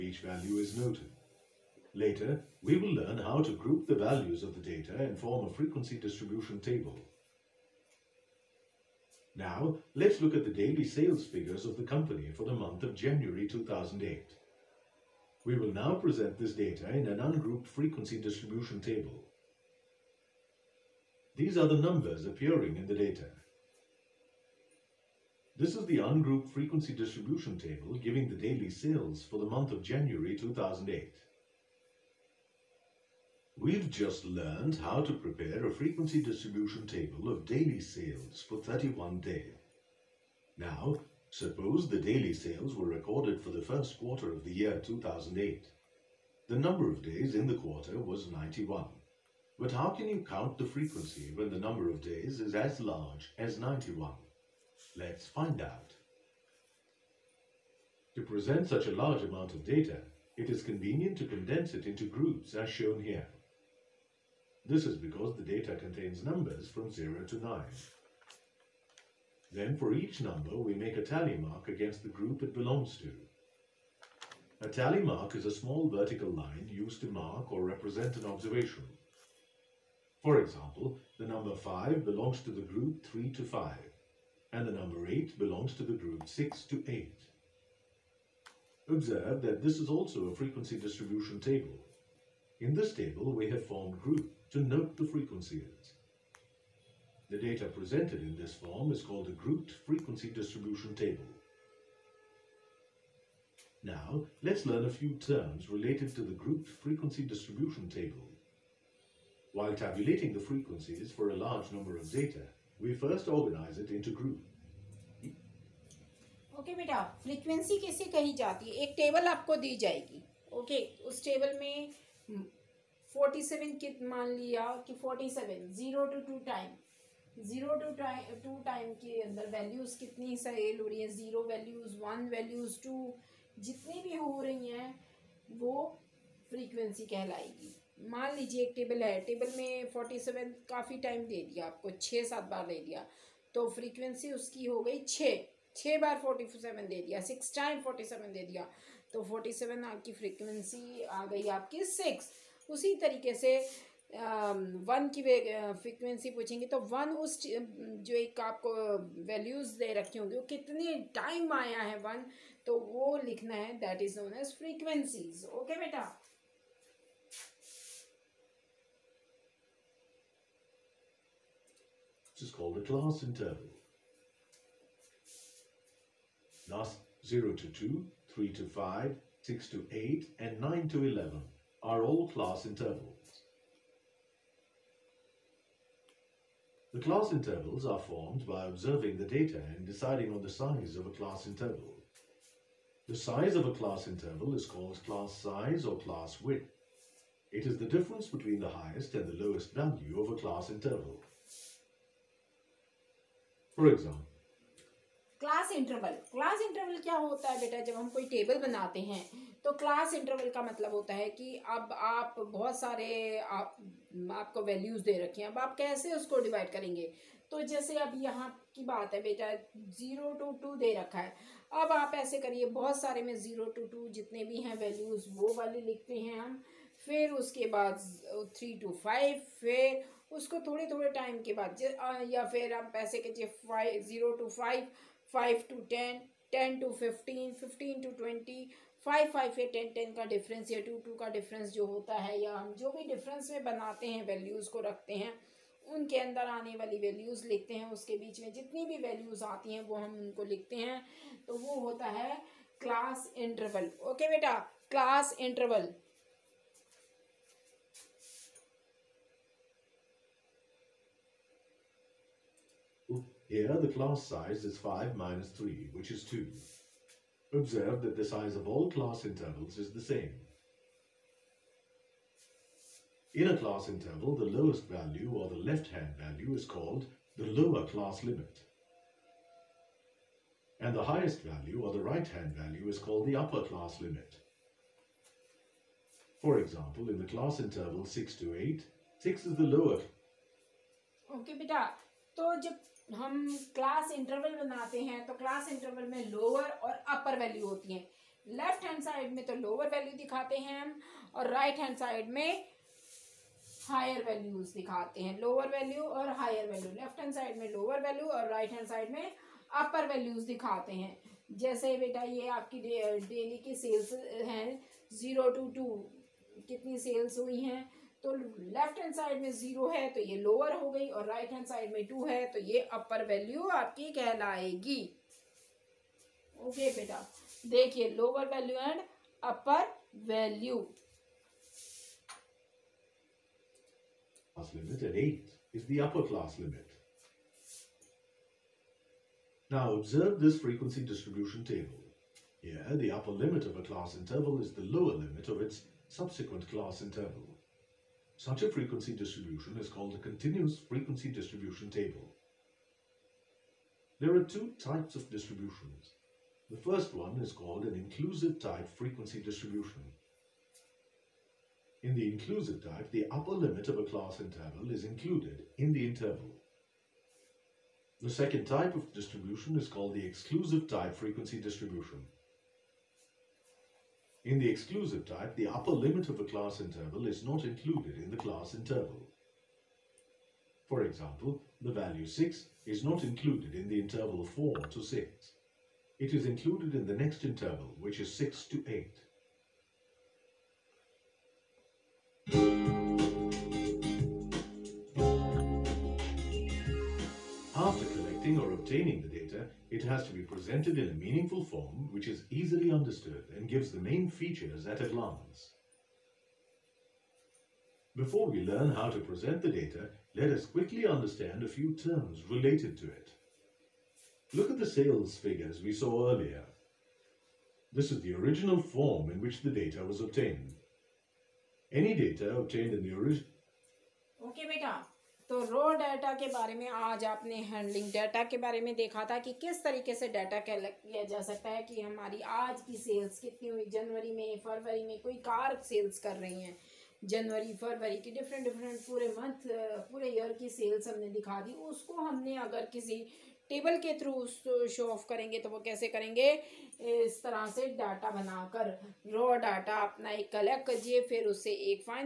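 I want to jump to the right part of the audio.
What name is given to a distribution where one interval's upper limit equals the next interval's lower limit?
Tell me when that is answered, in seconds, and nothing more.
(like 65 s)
350 s.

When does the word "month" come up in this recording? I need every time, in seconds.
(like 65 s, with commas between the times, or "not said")
12 s, 29 s.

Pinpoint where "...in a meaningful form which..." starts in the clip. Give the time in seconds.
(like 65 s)
400 s.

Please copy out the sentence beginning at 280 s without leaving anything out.
And the highest value or the right-hand value is called the upper class limit.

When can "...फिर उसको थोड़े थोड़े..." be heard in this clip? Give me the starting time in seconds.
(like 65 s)
229 s.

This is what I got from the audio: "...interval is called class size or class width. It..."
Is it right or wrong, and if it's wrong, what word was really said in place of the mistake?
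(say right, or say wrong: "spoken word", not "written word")
right.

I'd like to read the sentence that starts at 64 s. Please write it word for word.
This is because the data contains numbers from 0 to 9.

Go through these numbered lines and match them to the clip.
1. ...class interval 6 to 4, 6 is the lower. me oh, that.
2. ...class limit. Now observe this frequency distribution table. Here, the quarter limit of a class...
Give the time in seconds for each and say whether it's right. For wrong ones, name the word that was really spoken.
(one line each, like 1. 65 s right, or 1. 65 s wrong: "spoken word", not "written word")
1. 287 s wrong: "8", not "4"
2. 336 s wrong: "upper", not "quarter".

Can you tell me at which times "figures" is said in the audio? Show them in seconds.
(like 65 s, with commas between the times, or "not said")
11 s, 415 s.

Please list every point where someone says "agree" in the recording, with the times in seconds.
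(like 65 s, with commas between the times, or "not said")
not said.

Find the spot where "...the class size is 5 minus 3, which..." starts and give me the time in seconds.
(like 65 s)
263 s.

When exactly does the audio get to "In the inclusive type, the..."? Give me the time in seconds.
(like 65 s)
362 s.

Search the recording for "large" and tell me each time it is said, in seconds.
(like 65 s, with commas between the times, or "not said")
52 s, 58 s, 111 s.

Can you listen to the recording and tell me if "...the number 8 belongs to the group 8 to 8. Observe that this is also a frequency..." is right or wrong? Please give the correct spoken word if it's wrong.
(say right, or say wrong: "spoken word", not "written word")
wrong: "6", not "8".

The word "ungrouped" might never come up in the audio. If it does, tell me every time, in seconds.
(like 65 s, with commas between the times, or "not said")
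17 s, 25 s.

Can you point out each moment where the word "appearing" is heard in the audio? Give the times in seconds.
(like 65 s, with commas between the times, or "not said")
22 s.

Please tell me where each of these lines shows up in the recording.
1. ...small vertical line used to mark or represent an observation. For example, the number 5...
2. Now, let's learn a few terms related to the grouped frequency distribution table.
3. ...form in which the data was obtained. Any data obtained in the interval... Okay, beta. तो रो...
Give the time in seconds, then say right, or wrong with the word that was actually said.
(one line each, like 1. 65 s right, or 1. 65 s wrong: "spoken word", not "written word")
1. 75 s right
2. 103 s right
3. 418 s wrong: "original", not "interval".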